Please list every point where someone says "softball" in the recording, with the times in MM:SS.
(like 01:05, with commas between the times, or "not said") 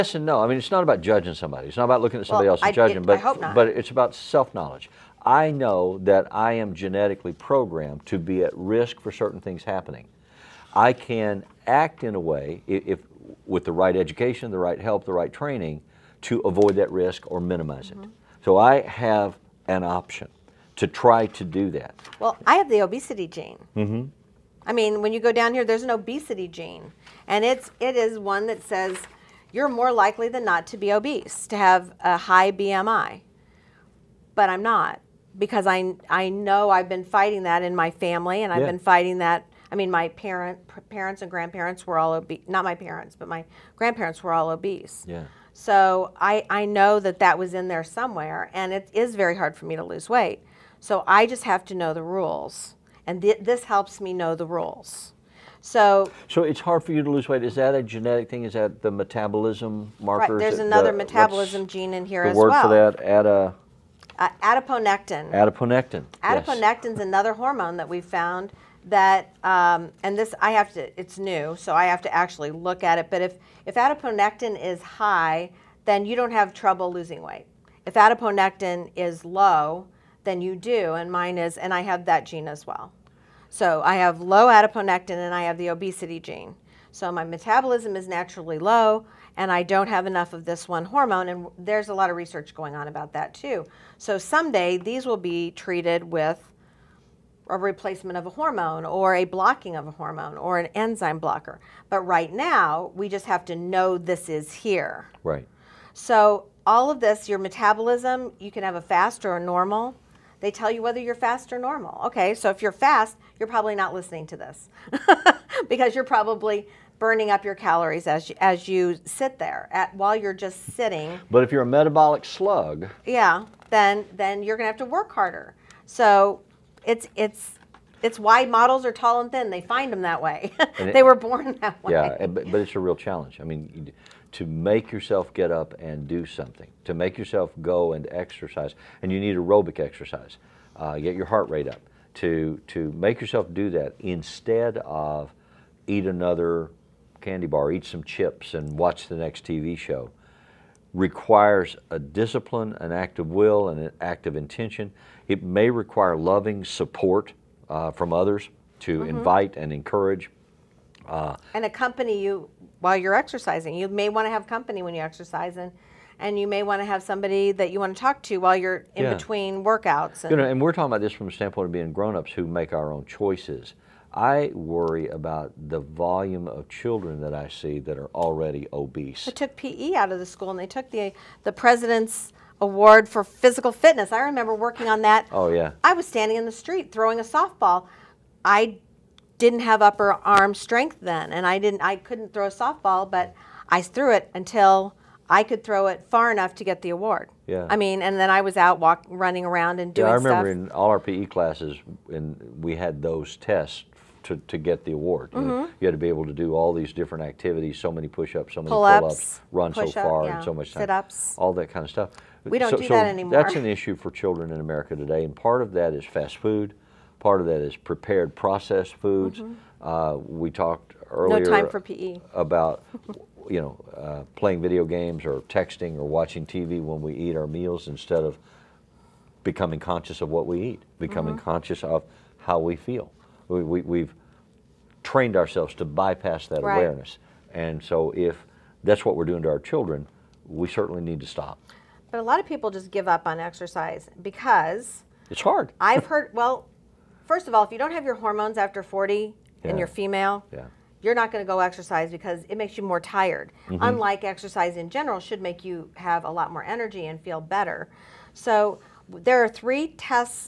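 03:07, 03:12.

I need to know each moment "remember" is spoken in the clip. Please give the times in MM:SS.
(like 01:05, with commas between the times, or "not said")
03:04, 03:20.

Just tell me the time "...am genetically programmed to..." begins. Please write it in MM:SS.
00:06.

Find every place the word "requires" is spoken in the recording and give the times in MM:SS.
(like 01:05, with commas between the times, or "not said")
02:30, 02:35.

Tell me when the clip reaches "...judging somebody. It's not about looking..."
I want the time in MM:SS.
00:01.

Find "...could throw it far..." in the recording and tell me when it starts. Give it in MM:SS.
03:15.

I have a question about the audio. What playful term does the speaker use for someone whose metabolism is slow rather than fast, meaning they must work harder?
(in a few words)
metabolic slug.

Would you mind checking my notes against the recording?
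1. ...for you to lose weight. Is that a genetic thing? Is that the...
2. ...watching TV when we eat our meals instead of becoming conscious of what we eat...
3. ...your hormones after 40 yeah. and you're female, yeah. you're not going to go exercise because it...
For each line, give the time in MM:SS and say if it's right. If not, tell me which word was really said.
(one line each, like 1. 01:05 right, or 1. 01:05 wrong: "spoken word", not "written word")
1. 00:56 right
2. 03:46 right
3. 04:08 right.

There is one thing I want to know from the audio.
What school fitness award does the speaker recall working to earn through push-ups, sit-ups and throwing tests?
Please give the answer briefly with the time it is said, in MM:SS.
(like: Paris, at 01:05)
president's award, at 03:01.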